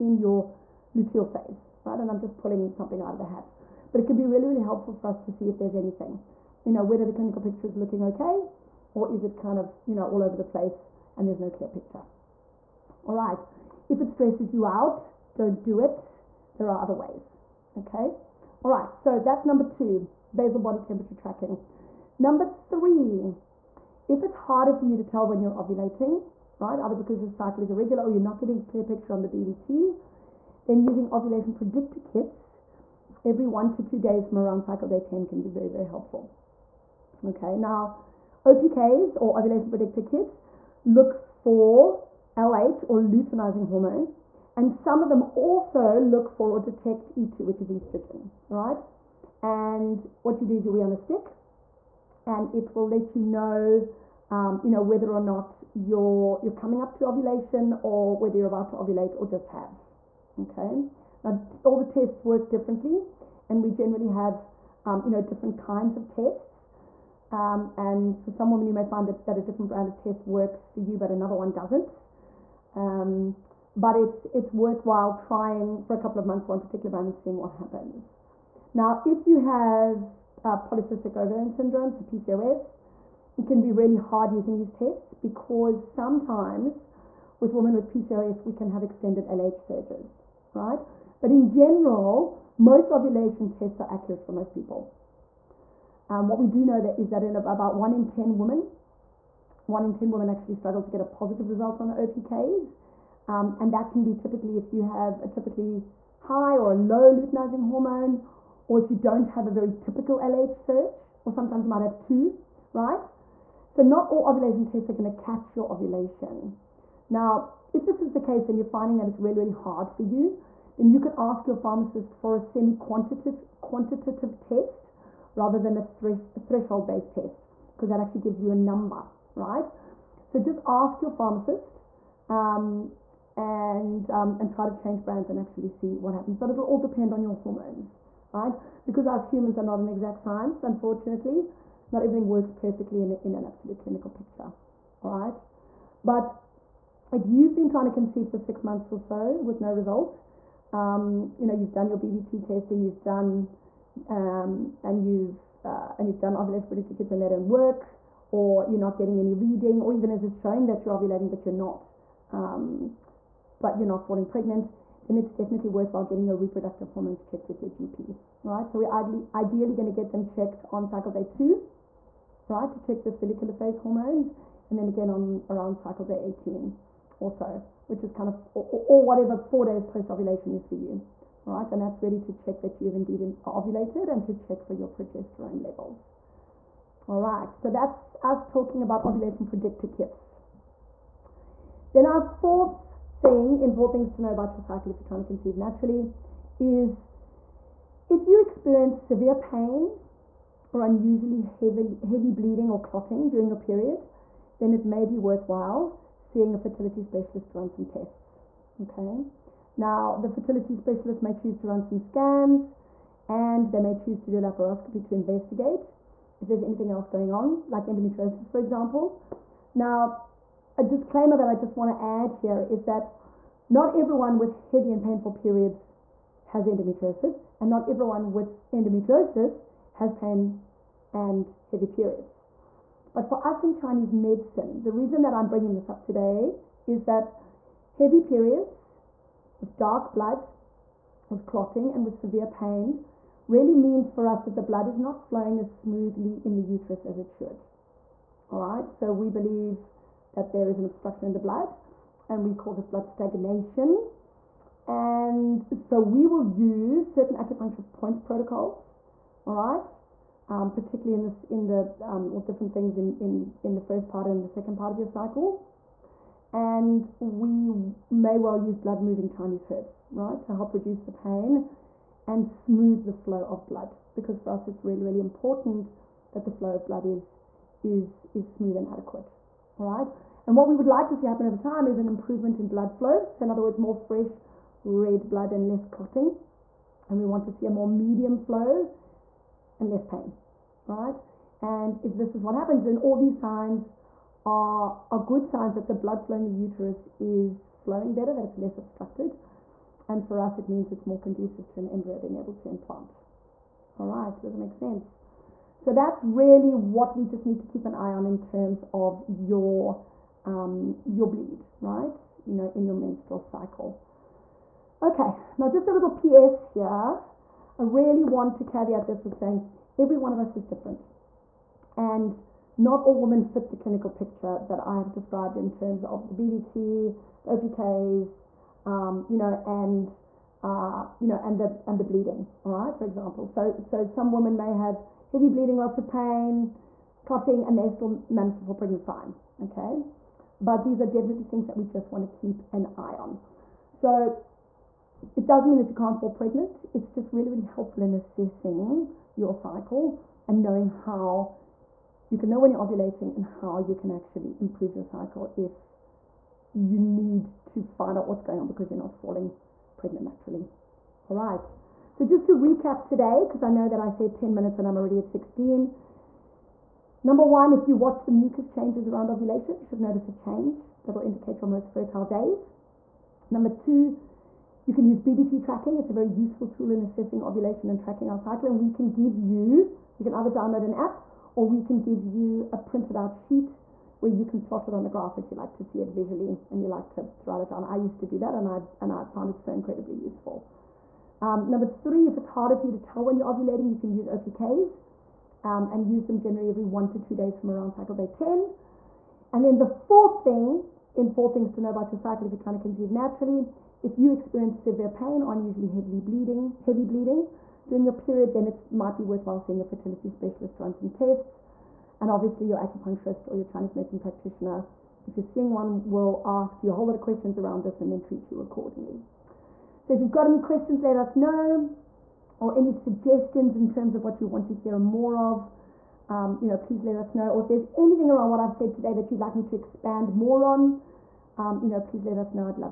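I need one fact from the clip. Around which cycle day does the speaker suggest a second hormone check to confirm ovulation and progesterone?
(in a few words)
Day 18.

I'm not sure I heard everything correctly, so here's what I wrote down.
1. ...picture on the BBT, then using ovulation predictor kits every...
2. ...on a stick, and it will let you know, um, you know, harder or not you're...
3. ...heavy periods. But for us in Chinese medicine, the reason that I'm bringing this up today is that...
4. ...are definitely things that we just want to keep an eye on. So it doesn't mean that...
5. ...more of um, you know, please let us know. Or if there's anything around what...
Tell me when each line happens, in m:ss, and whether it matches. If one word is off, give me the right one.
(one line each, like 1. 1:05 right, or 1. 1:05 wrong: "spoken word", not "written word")
1. 0:28 right
2. 0:50 wrong: "whether", not "harder"
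3. 3:51 right
4. 5:41 right
5. 7:04 right.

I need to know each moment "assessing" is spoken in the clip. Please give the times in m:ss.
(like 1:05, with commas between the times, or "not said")
5:48, 6:17.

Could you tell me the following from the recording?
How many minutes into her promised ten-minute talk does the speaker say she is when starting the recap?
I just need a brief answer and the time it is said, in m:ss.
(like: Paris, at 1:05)
16, at 6:05.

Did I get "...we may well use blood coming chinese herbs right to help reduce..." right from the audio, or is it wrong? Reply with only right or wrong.
wrong.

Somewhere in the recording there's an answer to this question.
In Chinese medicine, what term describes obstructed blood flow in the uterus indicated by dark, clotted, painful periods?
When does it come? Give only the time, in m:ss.
4:12.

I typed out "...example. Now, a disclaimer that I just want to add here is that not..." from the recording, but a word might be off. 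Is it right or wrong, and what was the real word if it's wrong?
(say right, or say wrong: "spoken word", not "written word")
right.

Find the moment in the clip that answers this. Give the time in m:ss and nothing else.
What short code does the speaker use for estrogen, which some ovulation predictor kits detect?
0:47.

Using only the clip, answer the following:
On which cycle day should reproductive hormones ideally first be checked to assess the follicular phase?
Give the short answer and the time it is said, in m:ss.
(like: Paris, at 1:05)
Day 2, at 2:50.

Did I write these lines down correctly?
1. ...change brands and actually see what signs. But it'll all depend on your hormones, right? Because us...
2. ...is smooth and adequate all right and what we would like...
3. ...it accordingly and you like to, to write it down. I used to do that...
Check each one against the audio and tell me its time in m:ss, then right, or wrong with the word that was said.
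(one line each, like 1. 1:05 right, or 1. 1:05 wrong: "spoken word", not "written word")
1. 2:14 wrong: "happens", not "signs"
2. 4:38 right
3. 6:25 wrong: "visually", not "accordingly".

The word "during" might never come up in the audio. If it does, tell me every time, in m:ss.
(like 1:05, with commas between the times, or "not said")
3:23, 6:47.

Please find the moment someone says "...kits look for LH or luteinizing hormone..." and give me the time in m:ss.
0:40.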